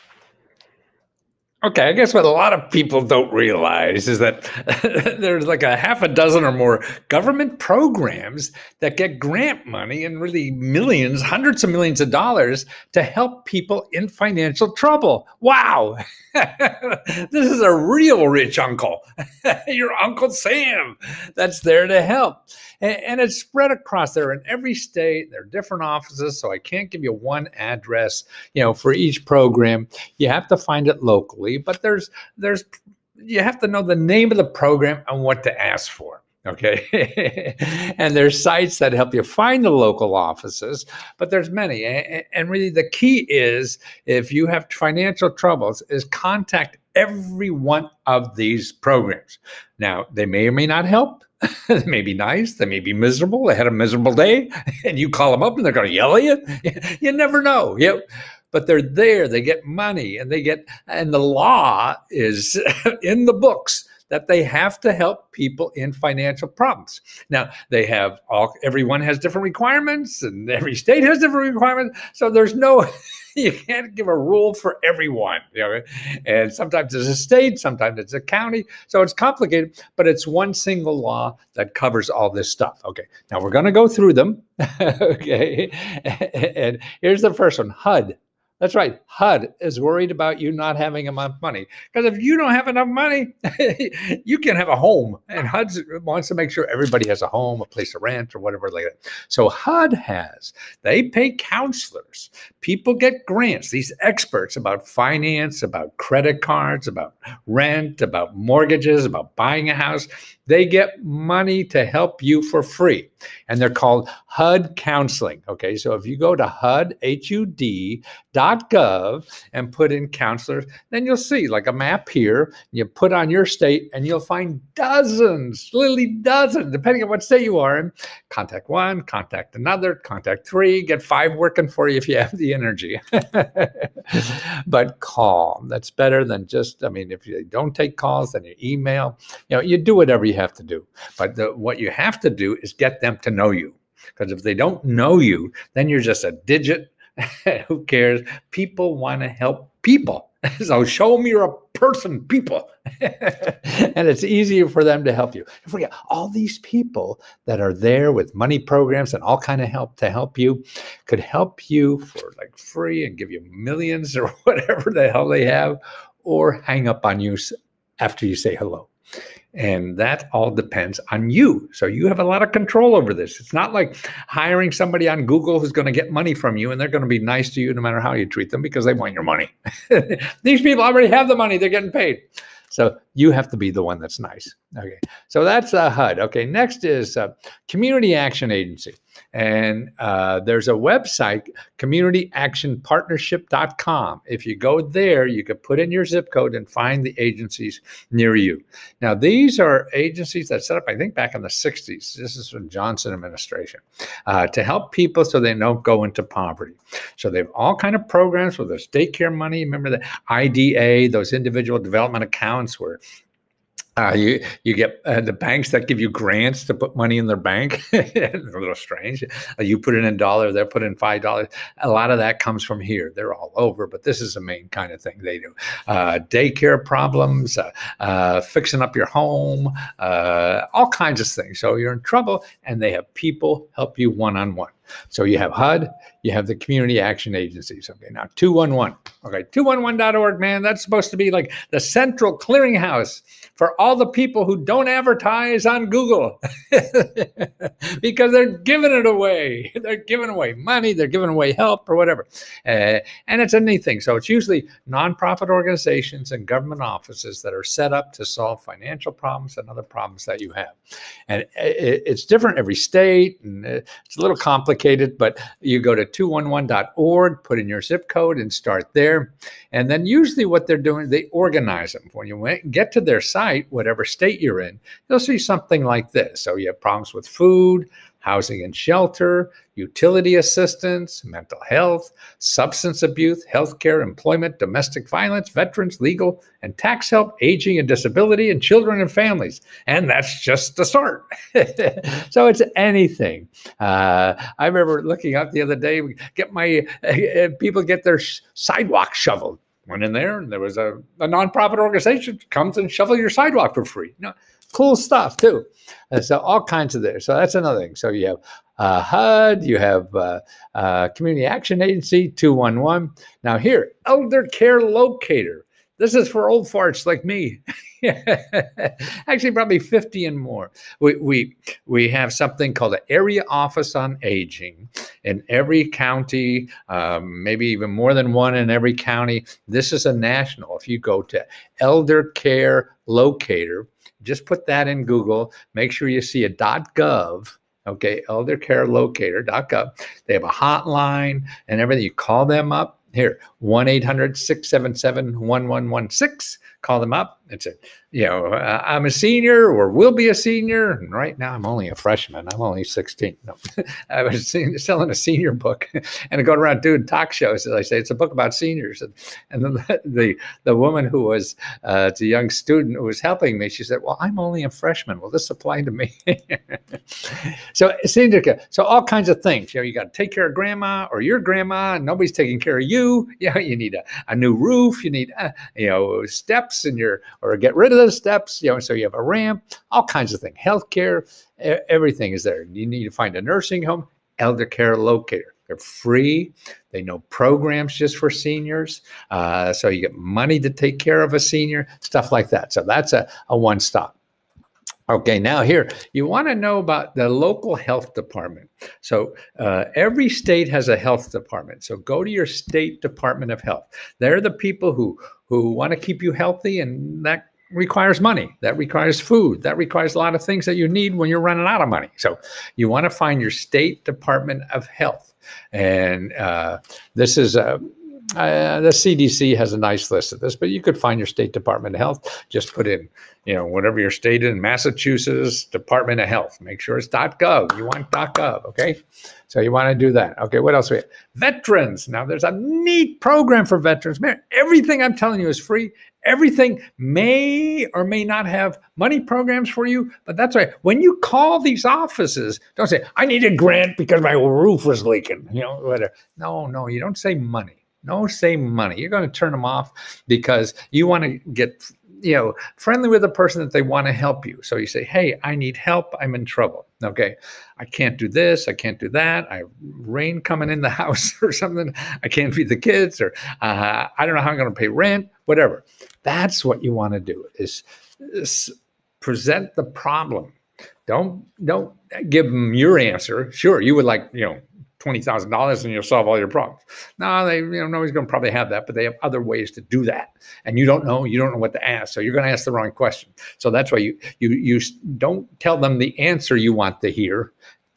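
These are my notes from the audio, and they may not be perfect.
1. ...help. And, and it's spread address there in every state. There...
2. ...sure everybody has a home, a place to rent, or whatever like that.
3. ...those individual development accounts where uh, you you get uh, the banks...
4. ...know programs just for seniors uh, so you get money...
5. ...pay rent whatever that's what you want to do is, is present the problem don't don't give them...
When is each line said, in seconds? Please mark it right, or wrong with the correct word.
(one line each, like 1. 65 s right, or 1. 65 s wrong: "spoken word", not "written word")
1. 22 s wrong: "across", not "address"
2. 96 s right
3. 211 s right
4. 387 s right
5. 464 s right.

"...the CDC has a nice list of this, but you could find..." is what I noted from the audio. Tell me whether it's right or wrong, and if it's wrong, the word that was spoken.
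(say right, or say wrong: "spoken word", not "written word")
right.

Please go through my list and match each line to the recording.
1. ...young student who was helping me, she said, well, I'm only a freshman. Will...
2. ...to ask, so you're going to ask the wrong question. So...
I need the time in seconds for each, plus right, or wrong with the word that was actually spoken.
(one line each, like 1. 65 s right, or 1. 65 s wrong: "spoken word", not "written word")
1. 362 s right
2. 481 s right.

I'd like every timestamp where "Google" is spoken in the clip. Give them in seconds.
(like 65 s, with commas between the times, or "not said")
175 s, 245 s, 335 s.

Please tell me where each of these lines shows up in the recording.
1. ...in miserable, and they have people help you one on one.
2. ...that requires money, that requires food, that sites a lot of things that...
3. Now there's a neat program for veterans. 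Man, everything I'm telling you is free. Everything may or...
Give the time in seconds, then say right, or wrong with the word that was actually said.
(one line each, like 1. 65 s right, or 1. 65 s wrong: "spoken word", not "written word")
1. 231 s wrong: "trouble", not "miserable"
2. 407 s wrong: "requires", not "sites"
3. 432 s right.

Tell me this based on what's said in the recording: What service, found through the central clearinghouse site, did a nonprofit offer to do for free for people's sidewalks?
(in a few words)
Shovel your sidewalk.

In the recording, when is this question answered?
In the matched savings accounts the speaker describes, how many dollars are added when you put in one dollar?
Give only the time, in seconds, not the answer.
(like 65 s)
220 s.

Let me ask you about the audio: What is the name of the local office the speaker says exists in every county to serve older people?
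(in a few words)
Area Office on Aging.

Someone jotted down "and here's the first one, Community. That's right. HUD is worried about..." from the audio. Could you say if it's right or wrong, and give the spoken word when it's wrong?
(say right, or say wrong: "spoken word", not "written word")
wrong: "HUD", not "Community".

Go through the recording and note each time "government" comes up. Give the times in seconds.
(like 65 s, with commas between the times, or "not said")
7 s, 256 s.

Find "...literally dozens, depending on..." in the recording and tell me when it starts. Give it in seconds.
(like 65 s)
125 s.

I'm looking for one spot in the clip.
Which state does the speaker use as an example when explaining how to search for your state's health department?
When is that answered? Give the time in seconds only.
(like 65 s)
424 s.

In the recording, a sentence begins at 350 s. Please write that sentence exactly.
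And right now I'm only a freshman.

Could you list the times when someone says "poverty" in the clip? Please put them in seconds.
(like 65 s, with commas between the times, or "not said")
206 s.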